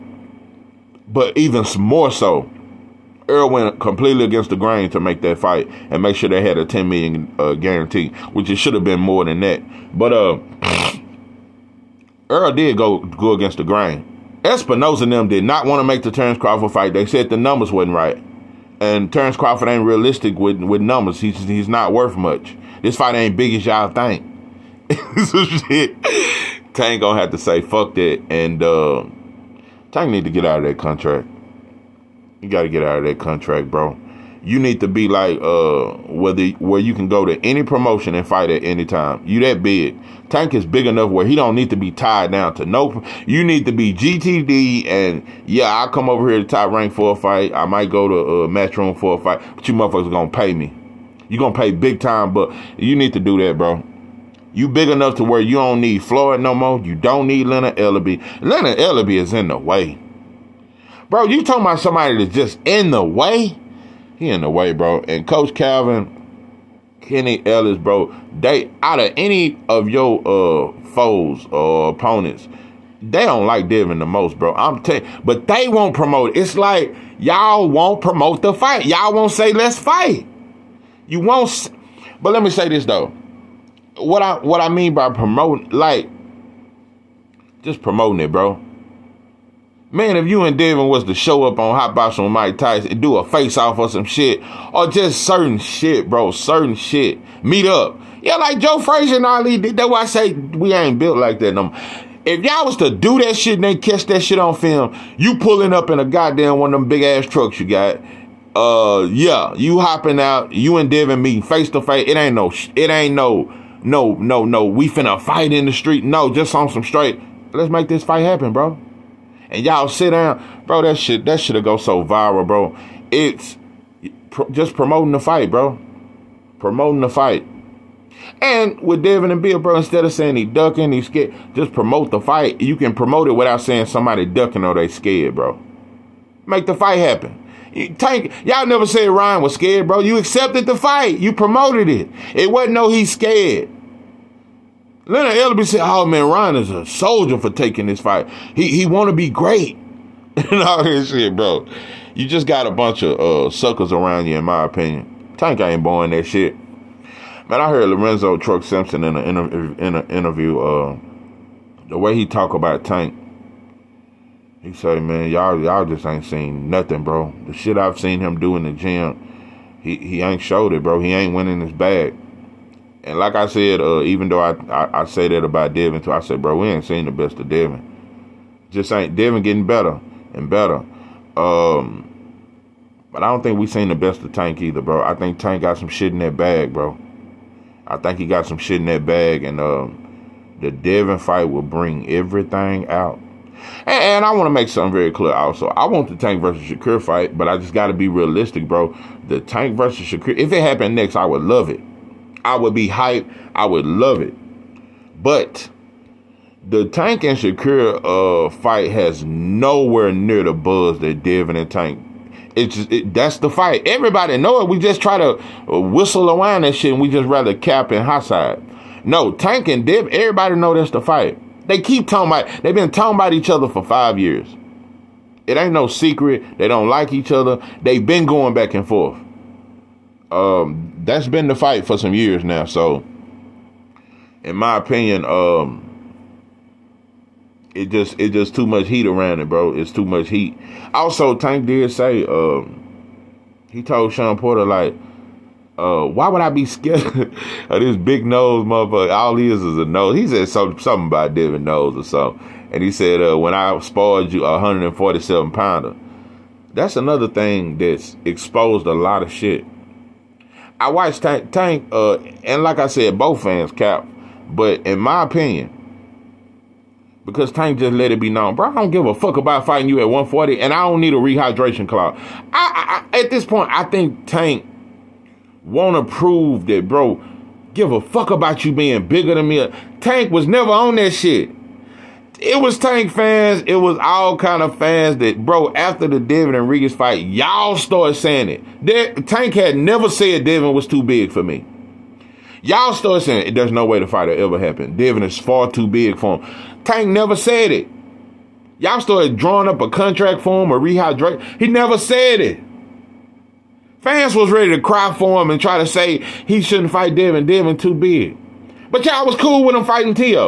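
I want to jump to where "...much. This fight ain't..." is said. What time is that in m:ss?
0:22.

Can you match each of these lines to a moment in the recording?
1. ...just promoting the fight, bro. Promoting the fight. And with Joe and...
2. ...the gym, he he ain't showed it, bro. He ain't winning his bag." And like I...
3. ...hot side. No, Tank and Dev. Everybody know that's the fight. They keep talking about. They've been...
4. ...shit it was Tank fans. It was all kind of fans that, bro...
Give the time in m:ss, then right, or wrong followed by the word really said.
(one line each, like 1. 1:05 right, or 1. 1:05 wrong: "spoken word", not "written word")
1. 2:04 wrong: "Devin", not "Joe"
2. 2:48 right
3. 3:38 right
4. 4:41 right.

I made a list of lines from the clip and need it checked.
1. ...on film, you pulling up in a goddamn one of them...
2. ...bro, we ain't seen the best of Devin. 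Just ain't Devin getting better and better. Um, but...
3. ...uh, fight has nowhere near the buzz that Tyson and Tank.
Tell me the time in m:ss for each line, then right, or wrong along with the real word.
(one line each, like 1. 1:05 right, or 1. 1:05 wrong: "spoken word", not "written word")
1. 1:44 right
2. 2:56 right
3. 3:28 wrong: "Devin", not "Tyson".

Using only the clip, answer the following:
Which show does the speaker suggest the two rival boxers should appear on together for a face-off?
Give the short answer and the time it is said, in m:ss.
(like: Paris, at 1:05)
Hot Box, at 1:31.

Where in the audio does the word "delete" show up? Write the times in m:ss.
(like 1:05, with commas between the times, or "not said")
not said.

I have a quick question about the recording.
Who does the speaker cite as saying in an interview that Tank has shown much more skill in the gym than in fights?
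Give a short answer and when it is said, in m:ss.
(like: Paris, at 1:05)
Lorenzo Truck Simpson, at 2:37.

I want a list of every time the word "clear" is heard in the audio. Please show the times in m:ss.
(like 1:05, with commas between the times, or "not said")
3:15.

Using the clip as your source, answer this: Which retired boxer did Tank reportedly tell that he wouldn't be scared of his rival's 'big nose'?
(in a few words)
Shawn Porter.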